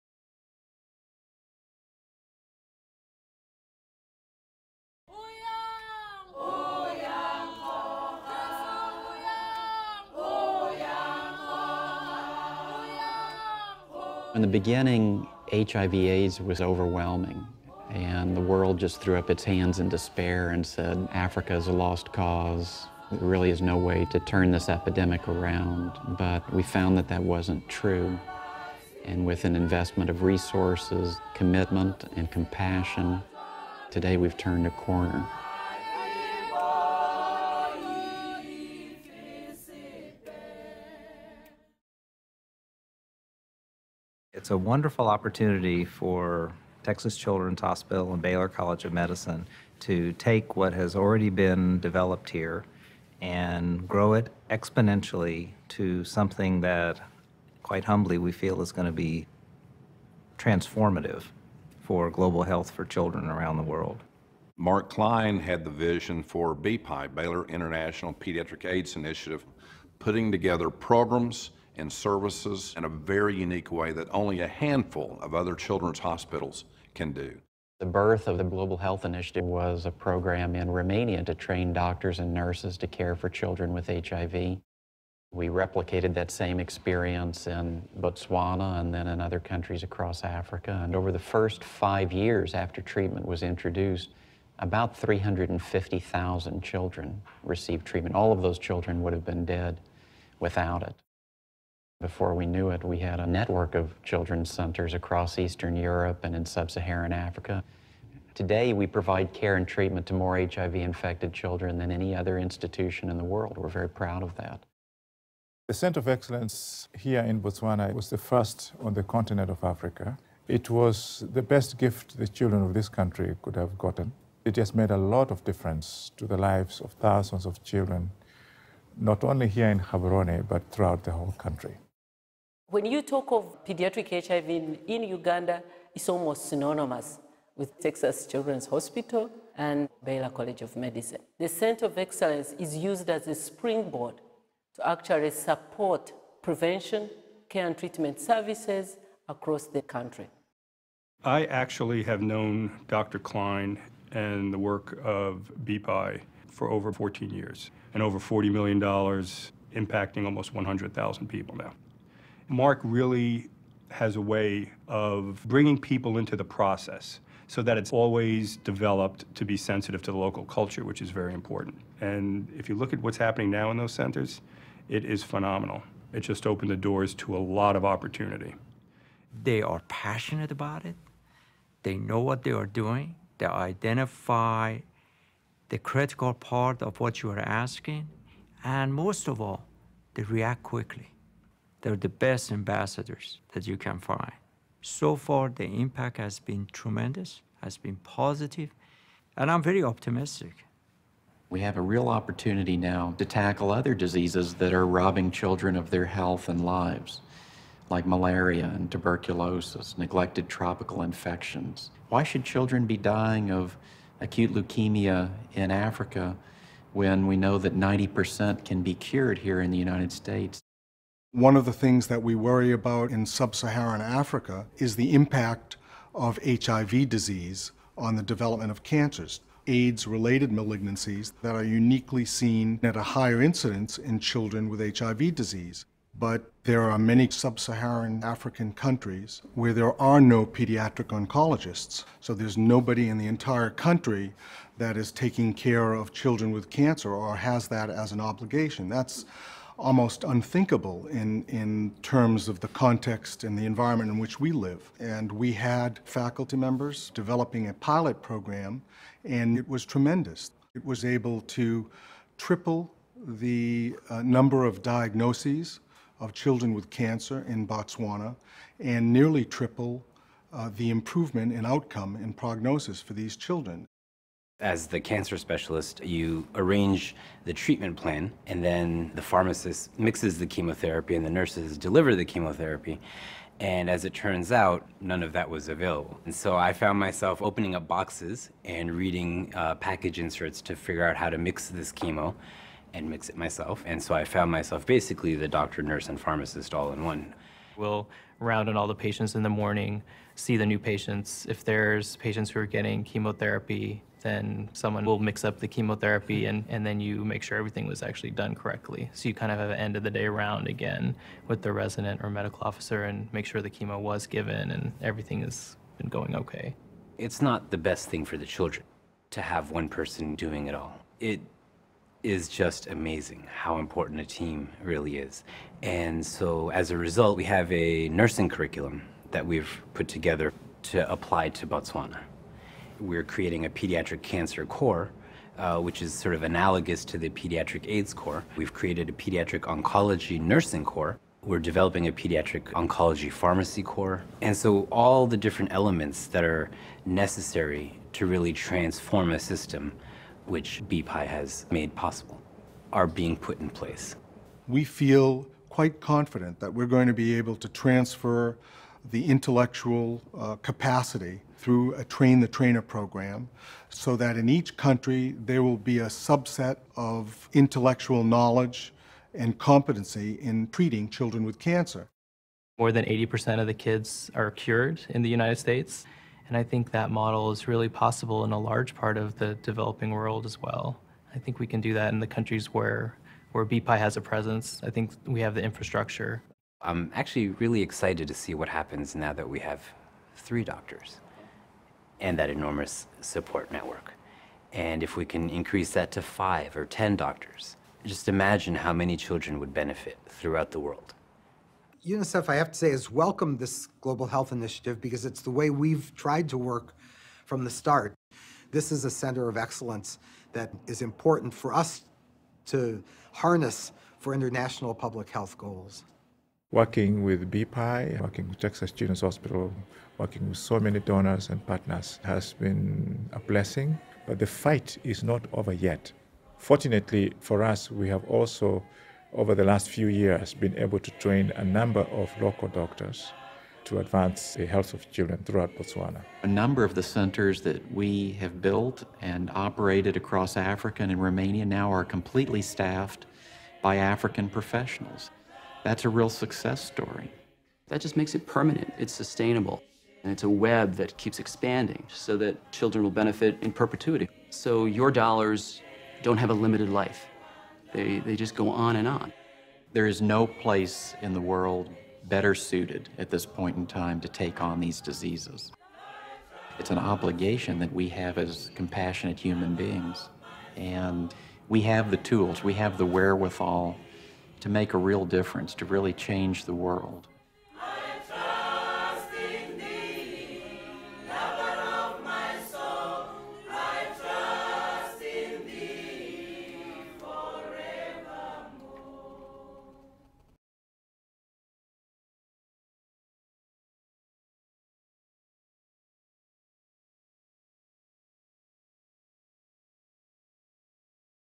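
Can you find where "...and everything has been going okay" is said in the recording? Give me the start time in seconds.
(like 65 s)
314 s.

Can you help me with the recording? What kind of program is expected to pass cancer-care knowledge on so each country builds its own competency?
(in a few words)
train the trainer.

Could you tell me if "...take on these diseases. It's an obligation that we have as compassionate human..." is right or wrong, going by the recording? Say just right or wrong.
right.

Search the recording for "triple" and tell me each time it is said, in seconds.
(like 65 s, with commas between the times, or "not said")
262 s, 269 s.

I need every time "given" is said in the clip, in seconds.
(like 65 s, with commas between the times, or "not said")
314 s.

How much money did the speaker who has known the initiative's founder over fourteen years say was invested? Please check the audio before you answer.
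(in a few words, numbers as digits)
$40 million.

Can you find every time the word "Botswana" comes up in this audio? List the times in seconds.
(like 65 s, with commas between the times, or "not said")
87 s, 117 s, 267 s, 331 s, 435 s.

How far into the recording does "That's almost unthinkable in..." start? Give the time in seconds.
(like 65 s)
248 s.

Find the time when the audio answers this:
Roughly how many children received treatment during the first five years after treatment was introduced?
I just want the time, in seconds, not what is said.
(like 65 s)
94 s.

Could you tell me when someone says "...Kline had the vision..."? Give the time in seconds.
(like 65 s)
64 s.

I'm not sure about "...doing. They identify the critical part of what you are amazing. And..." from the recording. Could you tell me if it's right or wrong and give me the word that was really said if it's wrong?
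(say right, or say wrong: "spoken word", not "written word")
wrong: "asking", not "amazing".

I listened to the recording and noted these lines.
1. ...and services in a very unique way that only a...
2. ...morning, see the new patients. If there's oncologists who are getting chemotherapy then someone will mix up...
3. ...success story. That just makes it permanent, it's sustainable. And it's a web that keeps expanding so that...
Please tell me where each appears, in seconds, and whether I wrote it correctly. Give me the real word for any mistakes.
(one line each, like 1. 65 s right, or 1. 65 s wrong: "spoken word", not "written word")
1. 71 s right
2. 299 s wrong: "patients", not "oncologists"
3. 446 s right.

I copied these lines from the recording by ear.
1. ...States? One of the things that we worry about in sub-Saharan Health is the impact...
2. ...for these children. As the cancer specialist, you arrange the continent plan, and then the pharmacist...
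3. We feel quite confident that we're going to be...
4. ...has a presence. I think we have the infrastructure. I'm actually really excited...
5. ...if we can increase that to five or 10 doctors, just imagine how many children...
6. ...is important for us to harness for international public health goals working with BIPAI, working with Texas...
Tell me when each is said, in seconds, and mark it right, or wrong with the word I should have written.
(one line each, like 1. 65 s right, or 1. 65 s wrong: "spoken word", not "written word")
1. 220 s wrong: "Africa", not "Health"
2. 273 s wrong: "treatment", not "continent"
3. 354 s right
4. 383 s right
5. 395 s right
6. 410 s right.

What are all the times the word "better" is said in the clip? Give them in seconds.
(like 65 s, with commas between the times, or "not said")
462 s.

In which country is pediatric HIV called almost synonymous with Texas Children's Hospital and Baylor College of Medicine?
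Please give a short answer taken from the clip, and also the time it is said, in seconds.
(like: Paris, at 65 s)
Uganda, at 135 s.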